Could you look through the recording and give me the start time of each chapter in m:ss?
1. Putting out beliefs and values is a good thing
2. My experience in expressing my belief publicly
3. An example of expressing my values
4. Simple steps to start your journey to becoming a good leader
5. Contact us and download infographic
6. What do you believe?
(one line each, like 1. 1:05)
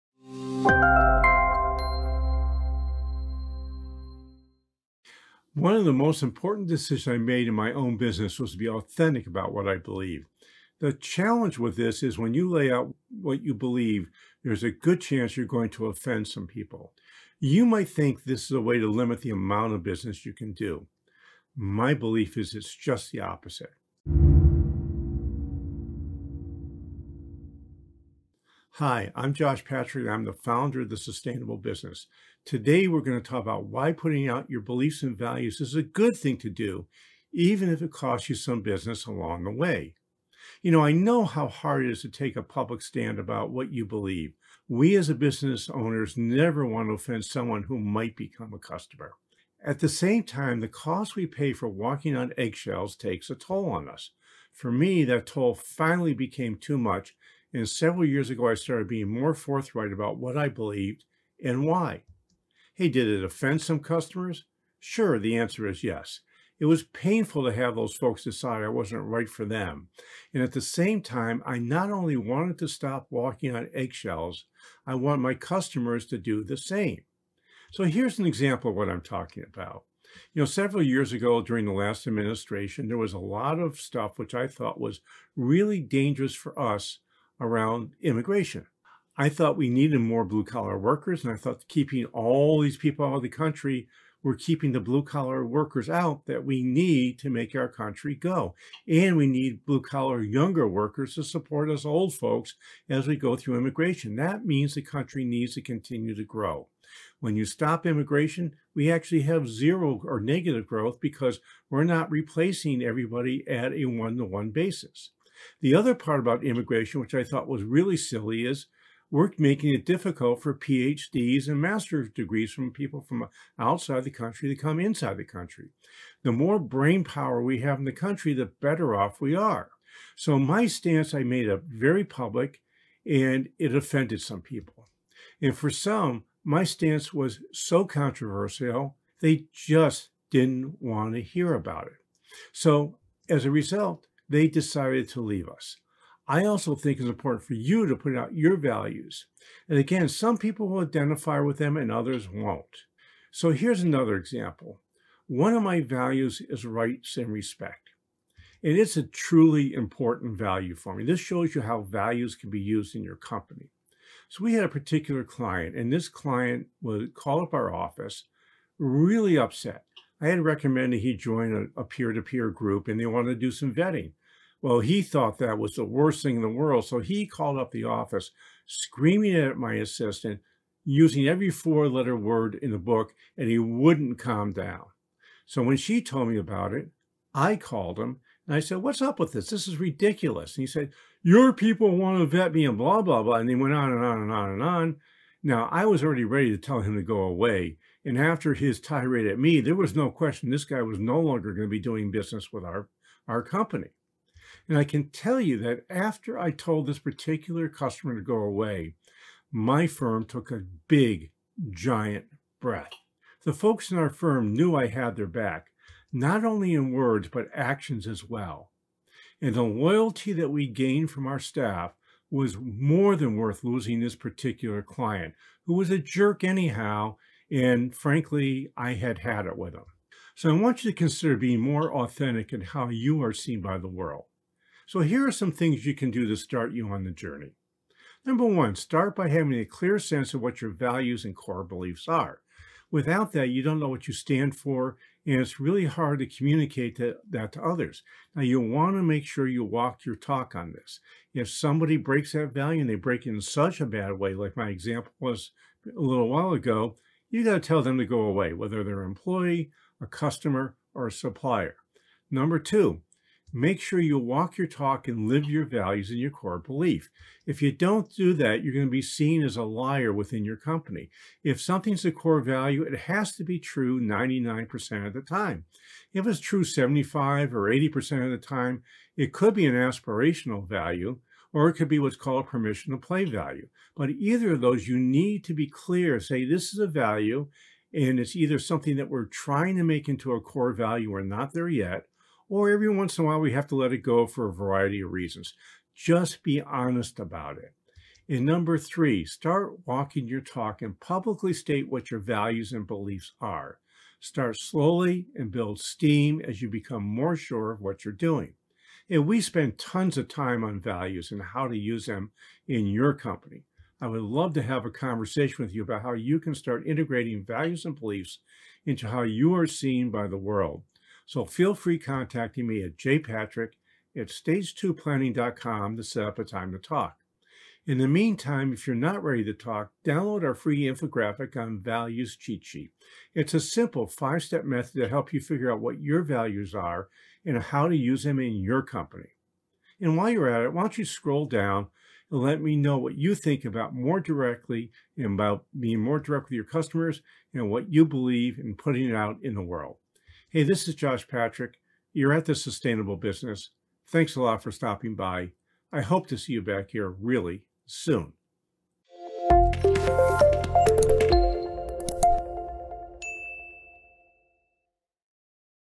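1. 0:28
2. 1:17
3. 2:33
4. 3:55
5. 5:21
6. 5:39.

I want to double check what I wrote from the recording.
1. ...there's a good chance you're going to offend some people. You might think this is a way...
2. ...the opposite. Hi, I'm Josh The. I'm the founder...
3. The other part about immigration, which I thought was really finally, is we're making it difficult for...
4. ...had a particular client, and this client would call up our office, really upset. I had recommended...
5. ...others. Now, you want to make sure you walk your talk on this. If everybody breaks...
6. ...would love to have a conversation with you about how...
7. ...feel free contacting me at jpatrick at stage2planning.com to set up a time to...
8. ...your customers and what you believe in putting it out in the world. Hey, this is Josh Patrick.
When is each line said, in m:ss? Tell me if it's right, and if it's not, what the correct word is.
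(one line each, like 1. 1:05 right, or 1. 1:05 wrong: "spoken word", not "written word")
1. 0:14 right
2. 0:23 wrong: "Patrick", not "The"
3. 1:55 wrong: "silly", not "finally"
4. 2:44 right
5. 4:07 wrong: "somebody", not "everybody"
6. 5:14 right
7. 5:21 right
8. 5:46 right.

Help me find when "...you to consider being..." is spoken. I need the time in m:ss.
3:50.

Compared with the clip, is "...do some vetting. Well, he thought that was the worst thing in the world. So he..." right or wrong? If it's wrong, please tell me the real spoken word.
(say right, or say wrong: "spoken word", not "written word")
right.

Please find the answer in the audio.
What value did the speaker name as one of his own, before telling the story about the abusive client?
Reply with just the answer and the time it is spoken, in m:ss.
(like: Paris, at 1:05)
rights and respect, at 2:36.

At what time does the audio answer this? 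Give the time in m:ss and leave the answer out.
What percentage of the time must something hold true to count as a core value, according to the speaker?
4:33.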